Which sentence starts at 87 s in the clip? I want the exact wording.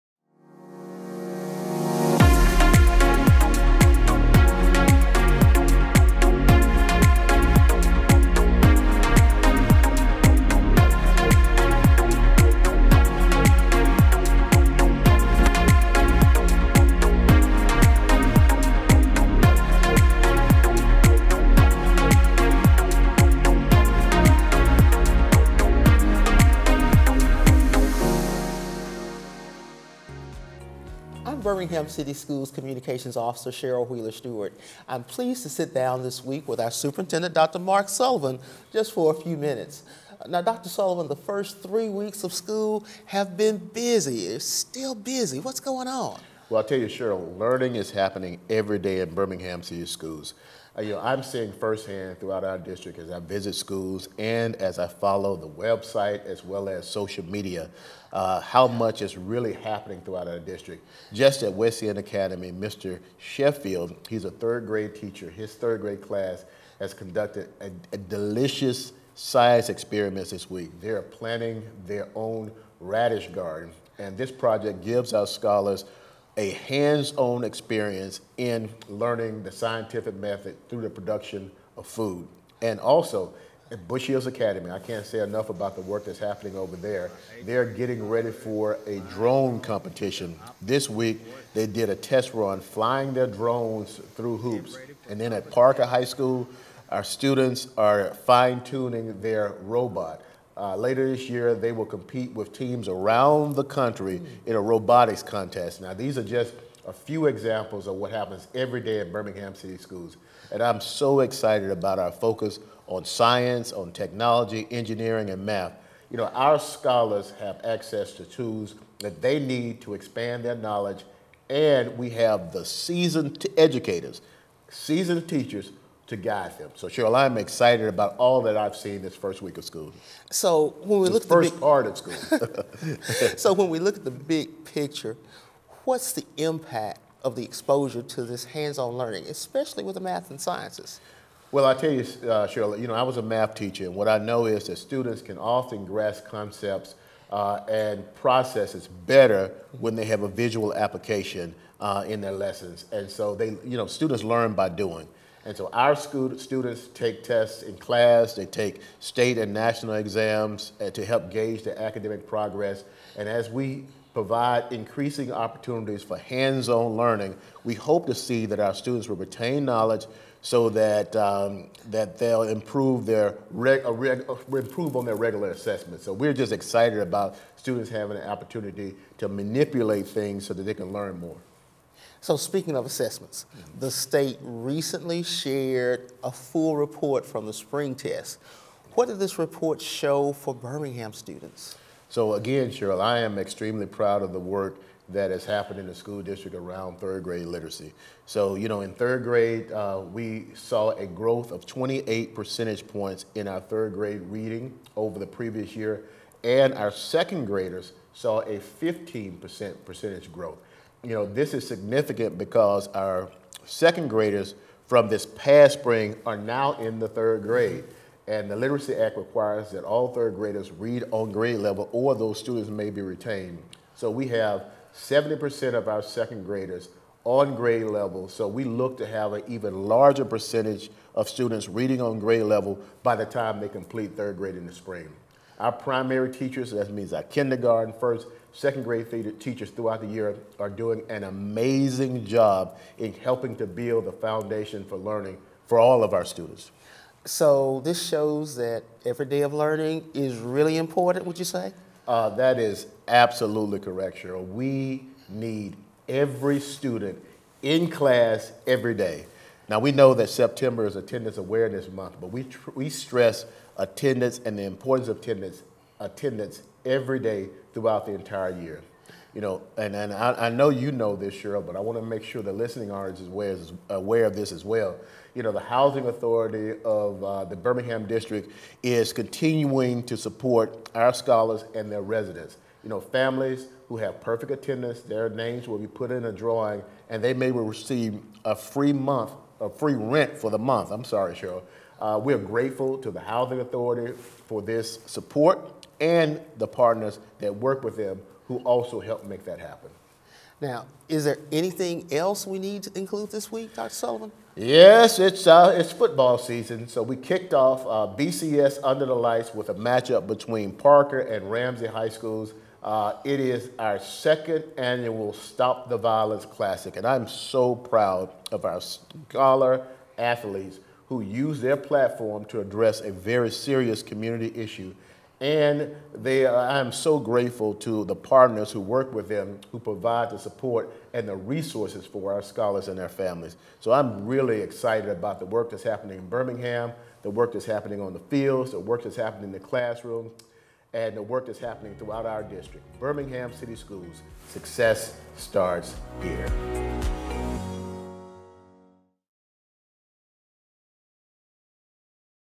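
They're getting ready for a drone competition.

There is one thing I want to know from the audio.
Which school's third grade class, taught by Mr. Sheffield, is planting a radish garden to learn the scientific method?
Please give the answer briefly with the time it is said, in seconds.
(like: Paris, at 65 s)
West End Academy, at 61 s.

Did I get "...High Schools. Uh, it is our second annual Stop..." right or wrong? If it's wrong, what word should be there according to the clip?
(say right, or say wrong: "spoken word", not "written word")
right.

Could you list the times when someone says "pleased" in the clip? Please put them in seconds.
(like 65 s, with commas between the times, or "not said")
35 s.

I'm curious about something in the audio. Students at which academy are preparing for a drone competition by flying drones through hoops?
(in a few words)
Bush Hills Academy.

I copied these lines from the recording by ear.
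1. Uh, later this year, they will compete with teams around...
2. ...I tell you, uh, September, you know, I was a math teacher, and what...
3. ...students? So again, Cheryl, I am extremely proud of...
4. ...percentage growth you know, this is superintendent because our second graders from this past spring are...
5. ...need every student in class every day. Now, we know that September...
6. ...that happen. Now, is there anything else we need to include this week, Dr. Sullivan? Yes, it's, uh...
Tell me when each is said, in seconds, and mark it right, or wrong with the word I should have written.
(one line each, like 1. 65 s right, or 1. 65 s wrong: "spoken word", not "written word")
1. 100 s right
2. 141 s wrong: "Cheryl", not "September"
3. 191 s right
4. 209 s wrong: "significant", not "superintendent"
5. 255 s right
6. 299 s right.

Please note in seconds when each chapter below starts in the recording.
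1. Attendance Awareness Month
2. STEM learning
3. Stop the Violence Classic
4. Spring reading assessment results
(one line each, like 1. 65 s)
1. 248 s
2. 60 s
3. 304 s
4. 182 s.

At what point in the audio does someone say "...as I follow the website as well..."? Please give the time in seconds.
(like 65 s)
54 s.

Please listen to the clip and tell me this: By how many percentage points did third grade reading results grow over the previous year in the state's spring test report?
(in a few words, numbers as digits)
28.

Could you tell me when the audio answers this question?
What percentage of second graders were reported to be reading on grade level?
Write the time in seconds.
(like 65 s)
224 s.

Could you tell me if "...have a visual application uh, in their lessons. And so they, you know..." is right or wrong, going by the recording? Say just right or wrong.
right.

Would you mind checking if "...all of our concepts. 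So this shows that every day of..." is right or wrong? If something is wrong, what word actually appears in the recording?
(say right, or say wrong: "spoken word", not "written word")
wrong: "students", not "concepts".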